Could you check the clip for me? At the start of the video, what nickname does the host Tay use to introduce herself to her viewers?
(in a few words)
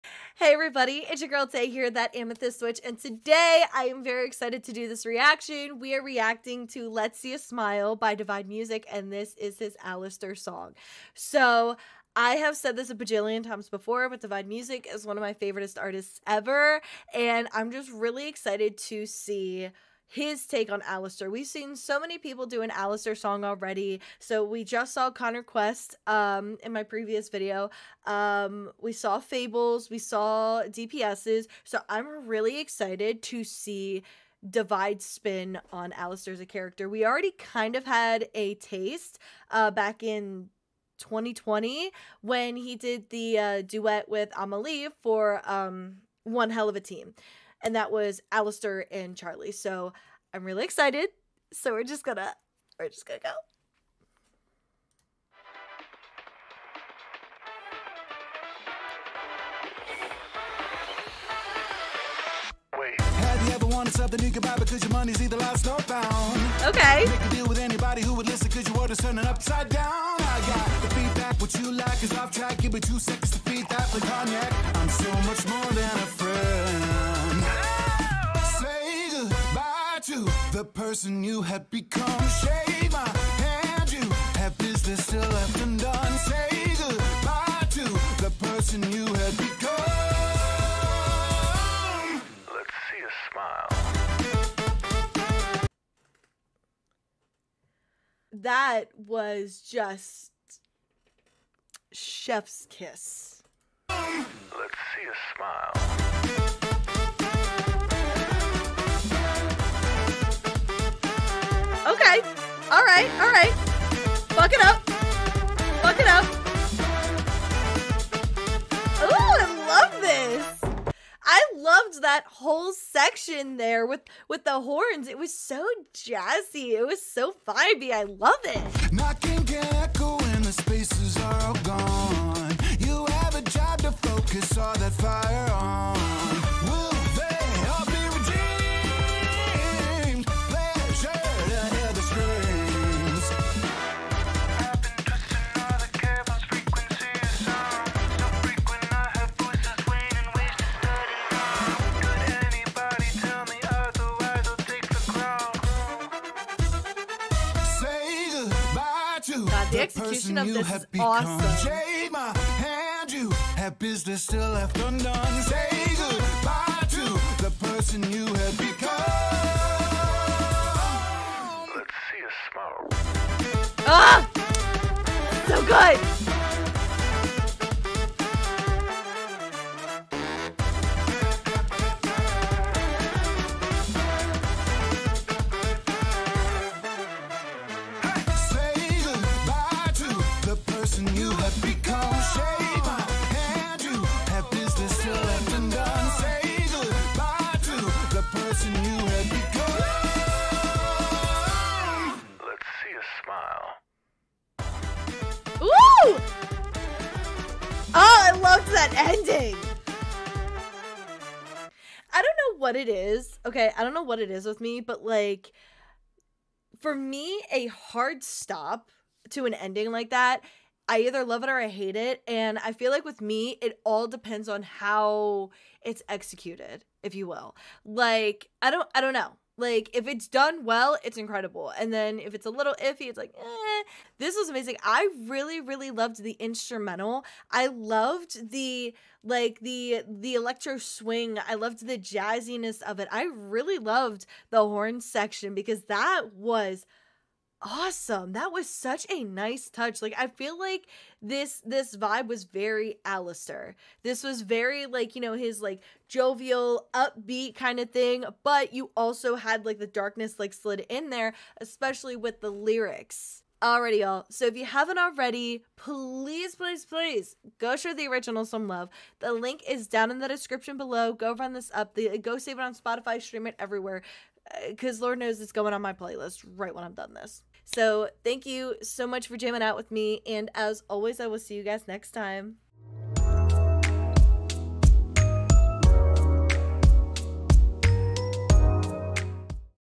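Amethyst Witch.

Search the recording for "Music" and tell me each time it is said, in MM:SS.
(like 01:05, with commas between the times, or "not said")
00:08, 00:14.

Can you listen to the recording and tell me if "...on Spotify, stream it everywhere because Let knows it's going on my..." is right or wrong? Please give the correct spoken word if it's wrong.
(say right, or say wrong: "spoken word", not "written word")
wrong: "Lord", not "Let".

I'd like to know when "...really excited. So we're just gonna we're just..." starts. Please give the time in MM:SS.
00:50.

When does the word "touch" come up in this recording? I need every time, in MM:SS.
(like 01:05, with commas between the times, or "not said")
04:09.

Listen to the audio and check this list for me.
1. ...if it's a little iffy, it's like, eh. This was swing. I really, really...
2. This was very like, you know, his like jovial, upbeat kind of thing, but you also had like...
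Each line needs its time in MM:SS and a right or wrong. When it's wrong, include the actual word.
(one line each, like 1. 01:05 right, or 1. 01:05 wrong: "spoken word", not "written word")
1. 03:52 wrong: "amazing", not "swing"
2. 04:14 right.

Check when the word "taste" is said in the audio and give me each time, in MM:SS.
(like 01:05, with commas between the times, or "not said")
00:38.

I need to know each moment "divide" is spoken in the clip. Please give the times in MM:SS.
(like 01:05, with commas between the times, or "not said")
00:08, 00:14, 00:34.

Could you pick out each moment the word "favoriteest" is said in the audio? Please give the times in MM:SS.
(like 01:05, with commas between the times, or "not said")
00:15.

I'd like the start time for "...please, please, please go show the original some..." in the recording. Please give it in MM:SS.
04:25.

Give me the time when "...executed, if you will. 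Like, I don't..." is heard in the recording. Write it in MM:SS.
03:46.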